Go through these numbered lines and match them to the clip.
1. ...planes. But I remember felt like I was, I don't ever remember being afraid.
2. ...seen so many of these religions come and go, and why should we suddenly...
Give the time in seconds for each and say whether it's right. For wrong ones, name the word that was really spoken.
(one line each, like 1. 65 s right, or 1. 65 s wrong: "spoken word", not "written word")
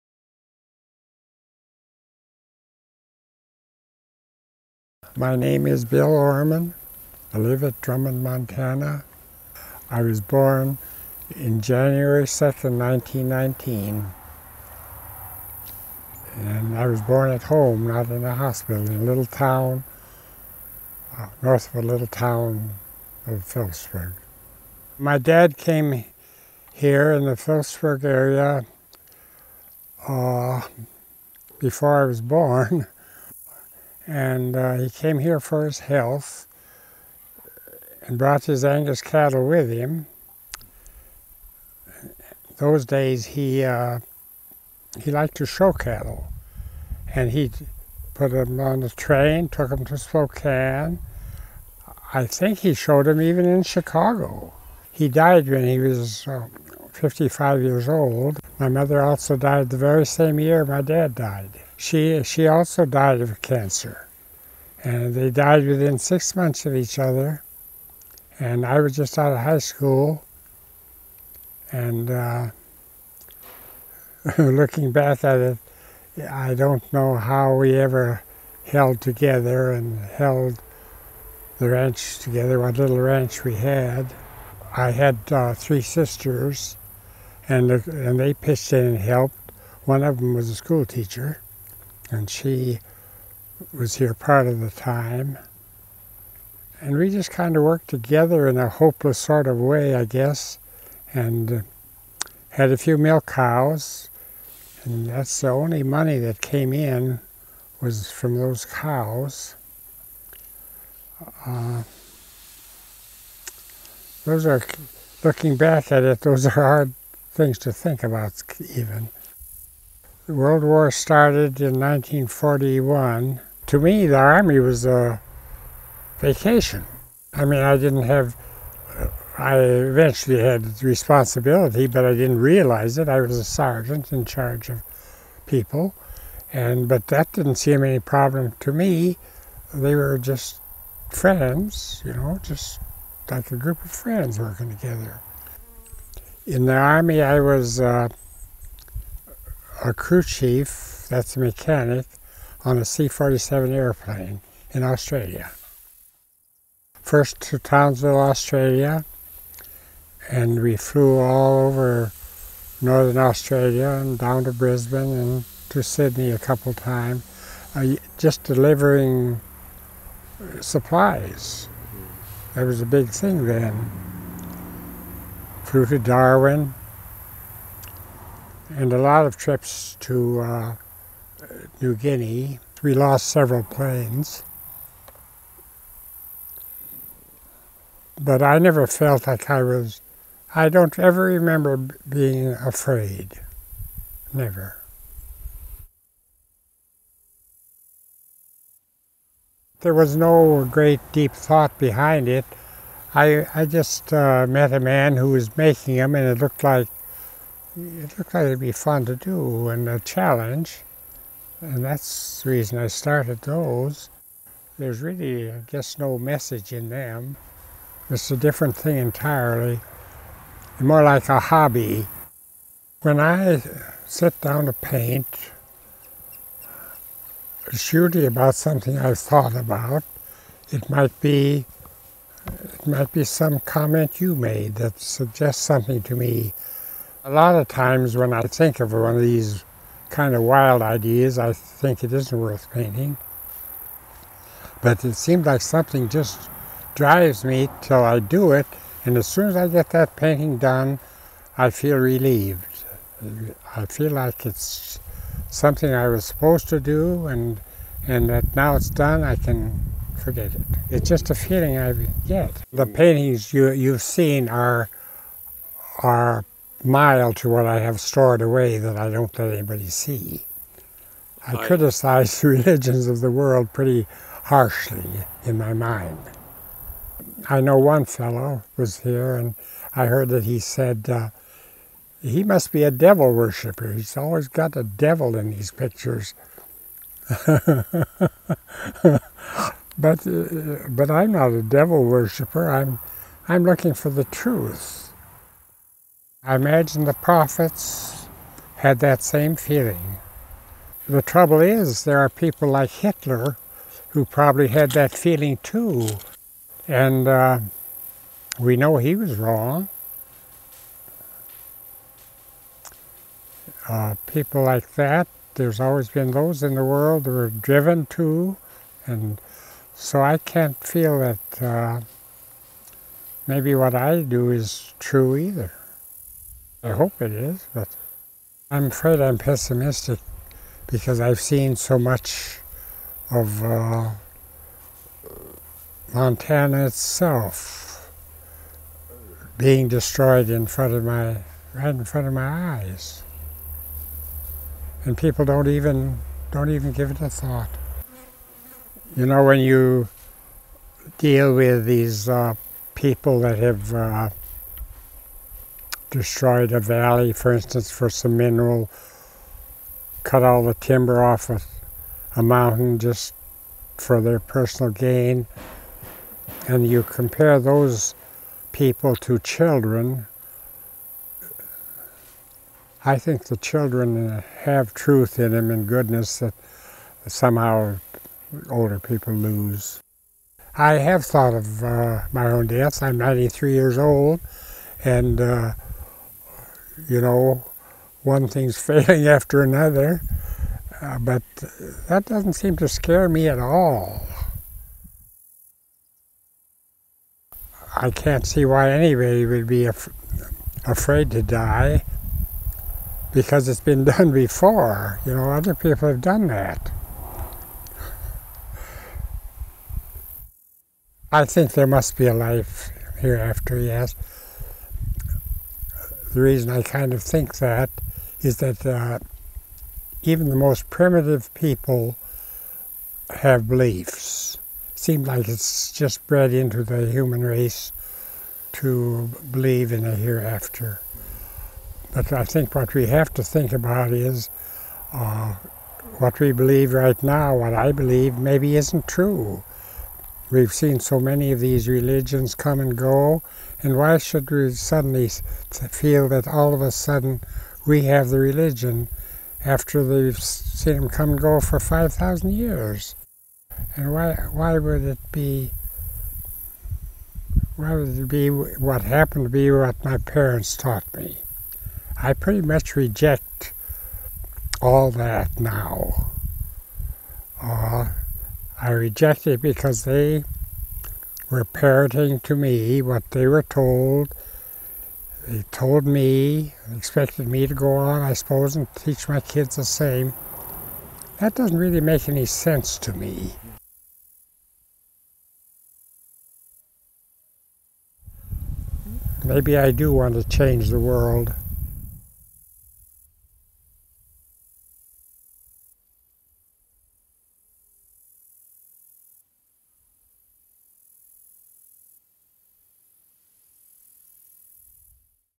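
1. 183 s wrong: "never", not "remember"
2. 440 s right.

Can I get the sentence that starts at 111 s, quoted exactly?
Uh, those are, looking back at it, those are hard things to think about even.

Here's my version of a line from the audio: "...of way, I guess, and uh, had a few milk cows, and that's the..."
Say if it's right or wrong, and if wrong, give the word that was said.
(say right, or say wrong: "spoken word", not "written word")
right.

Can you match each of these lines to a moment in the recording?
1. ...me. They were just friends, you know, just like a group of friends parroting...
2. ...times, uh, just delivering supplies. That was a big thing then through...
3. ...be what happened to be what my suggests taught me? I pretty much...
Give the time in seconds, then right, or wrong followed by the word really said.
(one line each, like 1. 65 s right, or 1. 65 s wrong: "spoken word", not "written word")
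1. 138 s wrong: "working", not "parroting"
2. 166 s right
3. 458 s wrong: "parents", not "suggests".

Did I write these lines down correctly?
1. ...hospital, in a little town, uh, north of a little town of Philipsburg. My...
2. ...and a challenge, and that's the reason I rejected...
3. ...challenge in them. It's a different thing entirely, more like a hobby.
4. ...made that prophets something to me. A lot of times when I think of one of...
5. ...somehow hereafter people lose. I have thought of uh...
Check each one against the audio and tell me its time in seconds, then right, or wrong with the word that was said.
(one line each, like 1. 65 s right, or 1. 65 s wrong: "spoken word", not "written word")
1. 18 s right
2. 209 s wrong: "started", not "rejected"
3. 216 s wrong: "message", not "challenge"
4. 234 s wrong: "suggests", not "prophets"
5. 377 s wrong: "older", not "hereafter".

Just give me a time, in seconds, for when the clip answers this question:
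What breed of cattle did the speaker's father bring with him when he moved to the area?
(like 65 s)
38 s.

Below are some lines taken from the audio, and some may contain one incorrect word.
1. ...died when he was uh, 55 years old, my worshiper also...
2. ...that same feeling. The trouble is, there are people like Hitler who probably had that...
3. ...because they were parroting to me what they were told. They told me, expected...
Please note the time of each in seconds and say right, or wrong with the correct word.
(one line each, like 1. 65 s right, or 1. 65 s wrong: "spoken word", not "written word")
1. 55 s wrong: "mother", not "worshiper"
2. 298 s right
3. 469 s right.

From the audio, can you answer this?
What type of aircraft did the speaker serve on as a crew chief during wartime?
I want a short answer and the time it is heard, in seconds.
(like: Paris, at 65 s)
C-47, at 152 s.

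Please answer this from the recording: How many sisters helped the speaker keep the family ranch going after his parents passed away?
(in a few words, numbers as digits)
3.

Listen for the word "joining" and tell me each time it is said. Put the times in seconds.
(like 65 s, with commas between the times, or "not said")
not said.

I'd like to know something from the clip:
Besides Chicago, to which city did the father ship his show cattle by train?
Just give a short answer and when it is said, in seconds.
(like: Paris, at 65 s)
Spokane, at 49 s.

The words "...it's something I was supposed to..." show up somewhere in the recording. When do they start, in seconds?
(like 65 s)
254 s.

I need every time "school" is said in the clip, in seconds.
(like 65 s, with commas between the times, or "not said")
69 s, 90 s.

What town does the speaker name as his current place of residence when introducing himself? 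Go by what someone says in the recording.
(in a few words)
Drummond, Montana.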